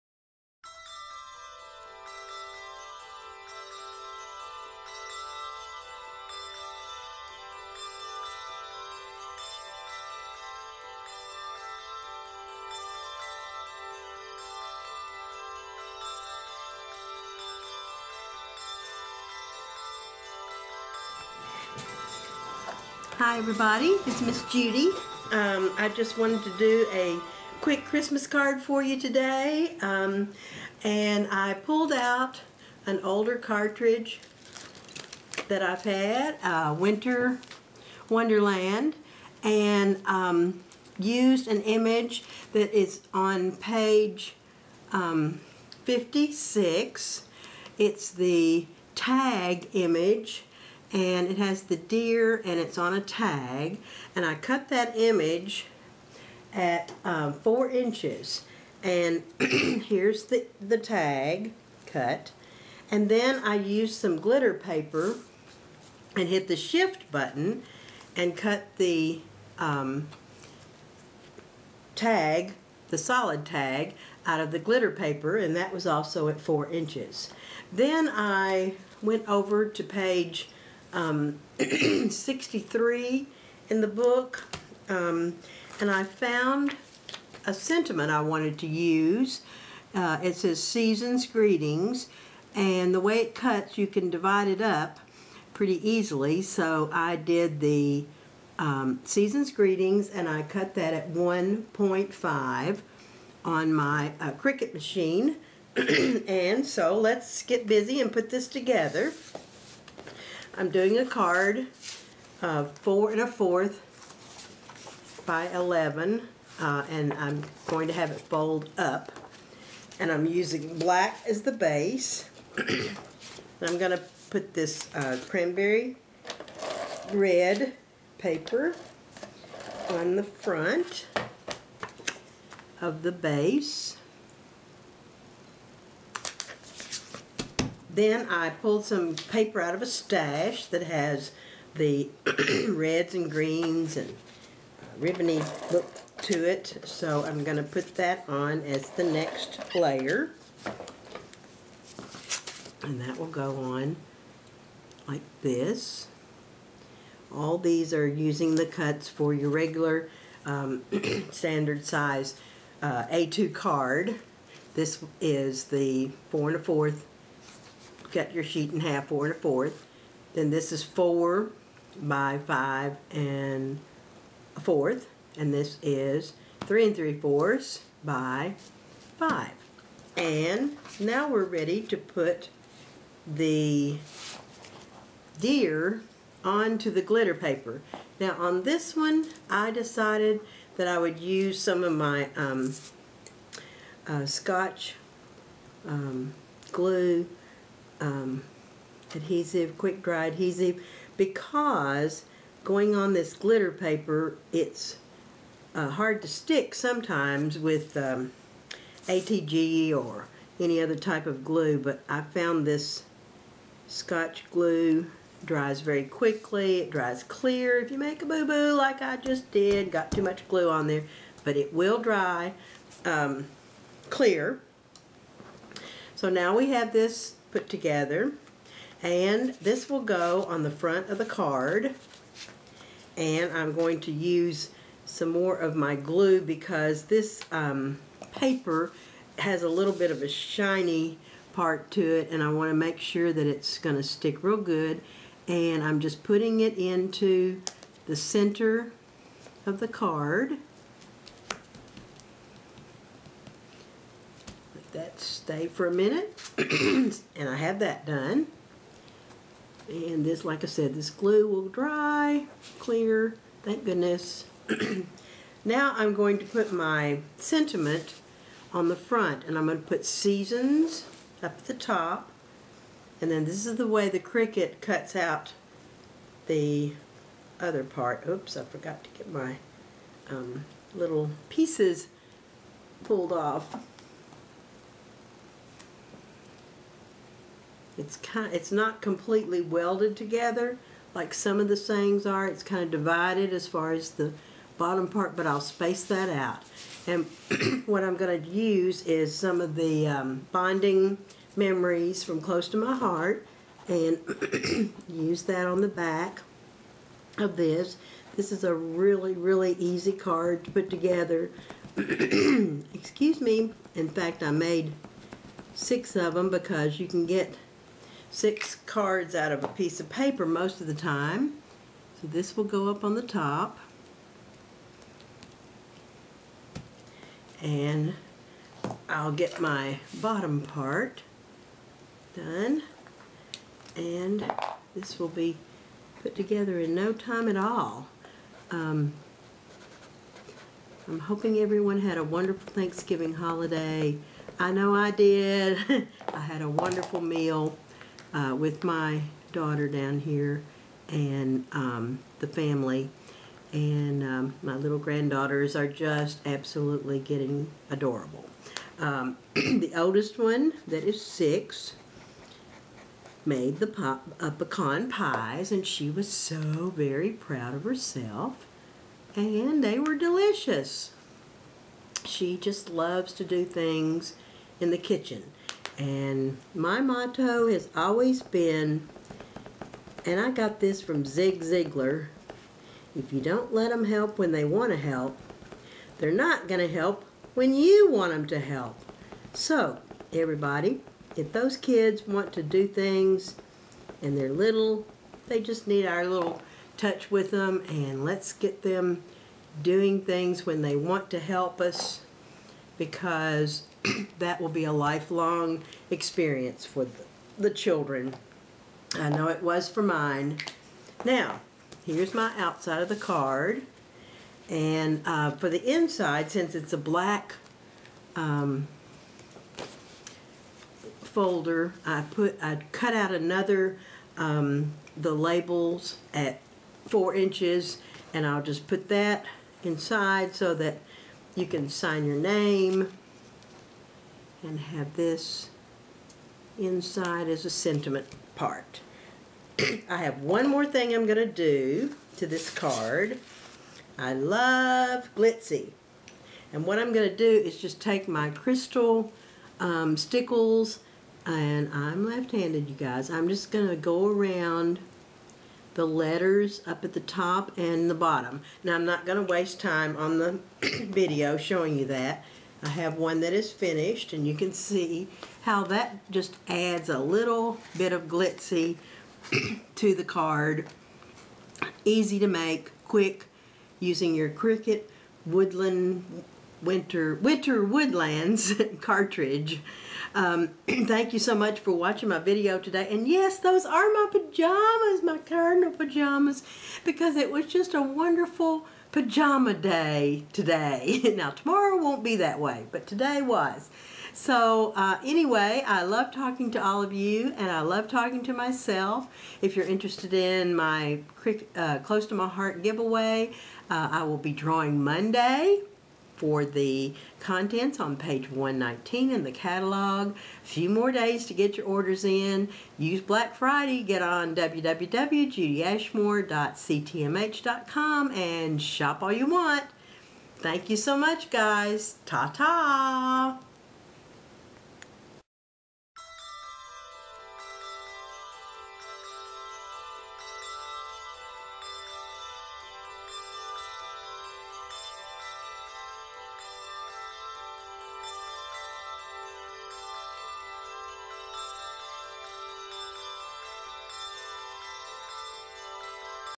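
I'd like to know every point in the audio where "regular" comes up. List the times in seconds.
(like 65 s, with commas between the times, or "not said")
159 s.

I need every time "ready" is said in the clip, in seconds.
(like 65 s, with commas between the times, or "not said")
181 s.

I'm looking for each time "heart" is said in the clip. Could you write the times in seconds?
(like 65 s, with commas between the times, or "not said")
302 s, 502 s.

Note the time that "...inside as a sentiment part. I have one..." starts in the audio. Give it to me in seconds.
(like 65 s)
436 s.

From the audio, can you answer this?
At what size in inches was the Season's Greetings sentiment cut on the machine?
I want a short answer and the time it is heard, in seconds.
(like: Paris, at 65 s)
1.5, at 101 s.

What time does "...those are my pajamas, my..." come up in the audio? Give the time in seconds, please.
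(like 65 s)
483 s.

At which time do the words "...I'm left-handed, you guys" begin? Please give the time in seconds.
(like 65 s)
451 s.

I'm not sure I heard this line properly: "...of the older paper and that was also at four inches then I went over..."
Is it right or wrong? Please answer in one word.
wrong.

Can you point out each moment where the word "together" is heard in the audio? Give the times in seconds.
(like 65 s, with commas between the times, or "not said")
108 s, 227 s, 290 s, 310 s, 336 s.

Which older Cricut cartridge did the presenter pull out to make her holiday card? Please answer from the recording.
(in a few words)
Winter Wonderland.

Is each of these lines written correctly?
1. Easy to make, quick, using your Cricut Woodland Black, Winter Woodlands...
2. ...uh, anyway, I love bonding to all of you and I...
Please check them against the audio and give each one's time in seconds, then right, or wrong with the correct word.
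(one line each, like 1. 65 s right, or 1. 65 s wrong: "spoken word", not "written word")
1. 472 s wrong: "Winter", not "Black"
2. 494 s wrong: "talking", not "bonding".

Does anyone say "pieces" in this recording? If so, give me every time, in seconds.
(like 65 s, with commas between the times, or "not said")
281 s, 319 s.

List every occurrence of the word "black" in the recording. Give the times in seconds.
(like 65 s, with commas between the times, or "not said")
120 s, 416 s, 513 s.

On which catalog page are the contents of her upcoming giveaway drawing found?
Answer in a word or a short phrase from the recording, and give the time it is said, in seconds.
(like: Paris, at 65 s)
119, at 508 s.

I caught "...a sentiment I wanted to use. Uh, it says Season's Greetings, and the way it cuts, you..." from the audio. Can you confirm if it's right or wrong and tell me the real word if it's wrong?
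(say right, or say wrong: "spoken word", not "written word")
right.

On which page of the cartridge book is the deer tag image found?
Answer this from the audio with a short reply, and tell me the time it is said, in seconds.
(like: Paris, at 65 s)
56, at 45 s.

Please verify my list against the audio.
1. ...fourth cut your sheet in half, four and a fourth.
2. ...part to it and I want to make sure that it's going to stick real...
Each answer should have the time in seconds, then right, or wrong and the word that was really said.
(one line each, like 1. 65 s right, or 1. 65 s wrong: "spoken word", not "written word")
1. 166 s right
2. 241 s right.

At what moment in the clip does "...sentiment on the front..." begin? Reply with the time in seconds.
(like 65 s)
267 s.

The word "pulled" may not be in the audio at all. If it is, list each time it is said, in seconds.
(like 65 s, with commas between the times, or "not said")
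31 s, 138 s, 283 s.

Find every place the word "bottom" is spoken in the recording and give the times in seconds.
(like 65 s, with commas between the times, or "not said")
294 s, 330 s, 458 s.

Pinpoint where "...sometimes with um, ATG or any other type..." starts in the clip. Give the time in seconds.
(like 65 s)
206 s.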